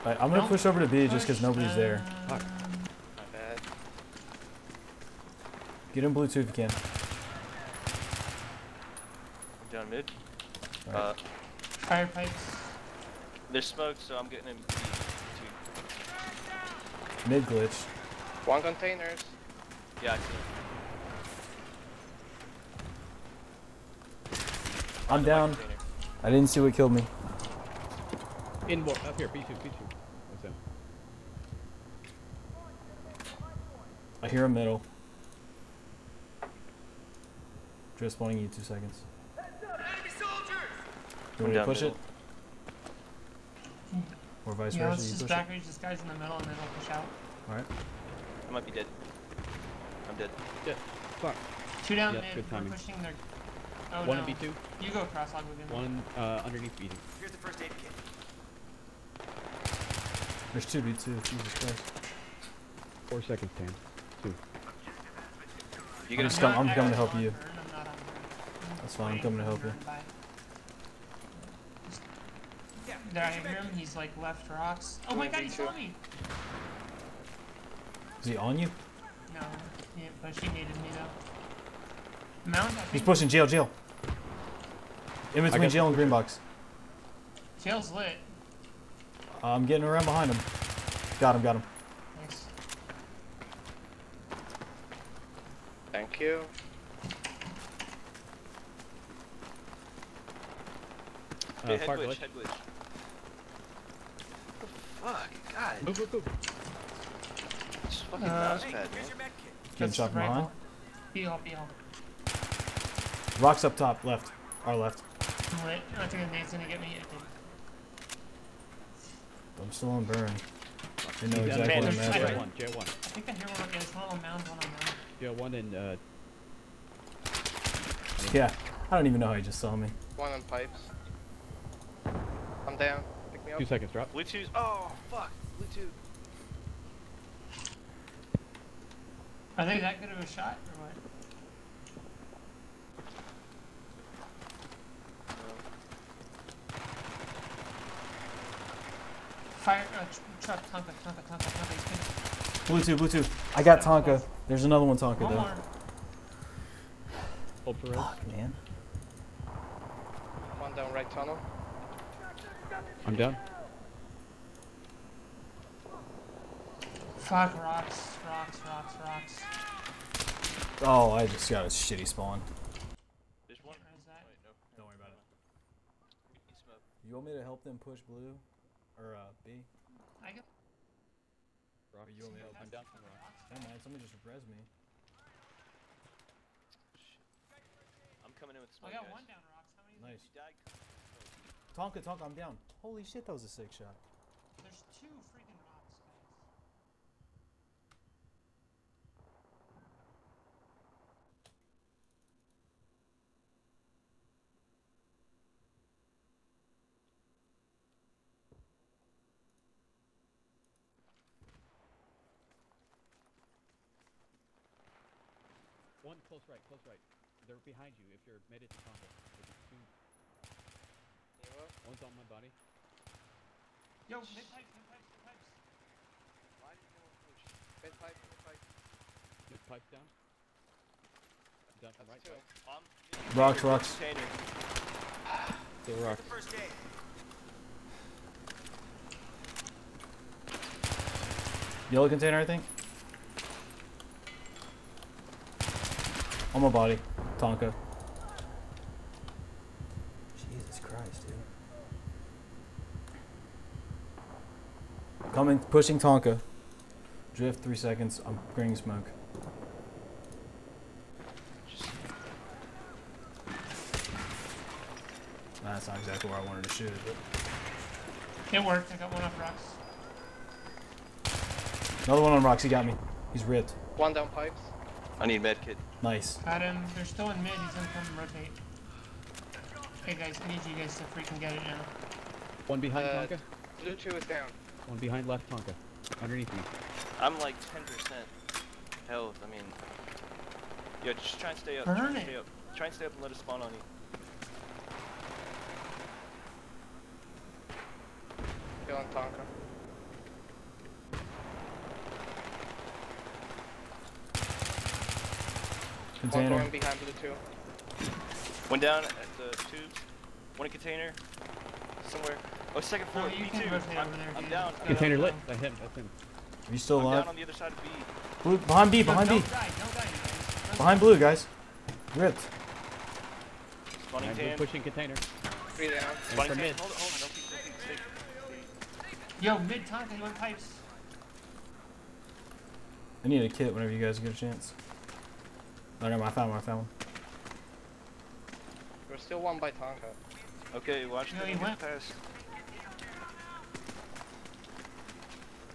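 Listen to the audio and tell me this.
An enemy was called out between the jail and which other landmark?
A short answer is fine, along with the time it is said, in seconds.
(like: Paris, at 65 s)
green box, at 85 s.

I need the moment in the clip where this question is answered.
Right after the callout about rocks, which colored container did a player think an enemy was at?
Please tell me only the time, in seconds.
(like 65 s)
241 s.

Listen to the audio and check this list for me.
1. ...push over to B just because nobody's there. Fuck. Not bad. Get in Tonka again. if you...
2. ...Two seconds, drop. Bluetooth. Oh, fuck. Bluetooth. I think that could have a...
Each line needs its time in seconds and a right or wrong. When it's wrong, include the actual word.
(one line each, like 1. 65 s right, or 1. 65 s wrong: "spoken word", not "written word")
1. 0 s wrong: "Bluetooth", not "Tonka"
2. 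133 s right.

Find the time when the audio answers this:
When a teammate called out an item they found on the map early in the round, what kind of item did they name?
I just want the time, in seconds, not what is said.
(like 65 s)
57 s.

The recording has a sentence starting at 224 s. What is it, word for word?
Yo, mid pipes, mid pipes, mid pipes.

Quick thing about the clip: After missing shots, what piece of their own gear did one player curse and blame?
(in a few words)
mouse pad.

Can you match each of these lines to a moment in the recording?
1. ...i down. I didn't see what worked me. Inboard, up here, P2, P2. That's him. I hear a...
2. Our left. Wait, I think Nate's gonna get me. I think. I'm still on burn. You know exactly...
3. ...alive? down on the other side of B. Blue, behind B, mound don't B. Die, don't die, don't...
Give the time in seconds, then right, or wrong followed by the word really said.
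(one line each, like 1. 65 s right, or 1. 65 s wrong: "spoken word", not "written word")
1. 25 s wrong: "killed", not "worked"
2. 114 s right
3. 317 s wrong: "behind", not "mound".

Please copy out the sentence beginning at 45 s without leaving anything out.
Let's just back reach this guy's in the middle and then we'll push out.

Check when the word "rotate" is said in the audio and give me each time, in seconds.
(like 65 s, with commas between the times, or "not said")
278 s.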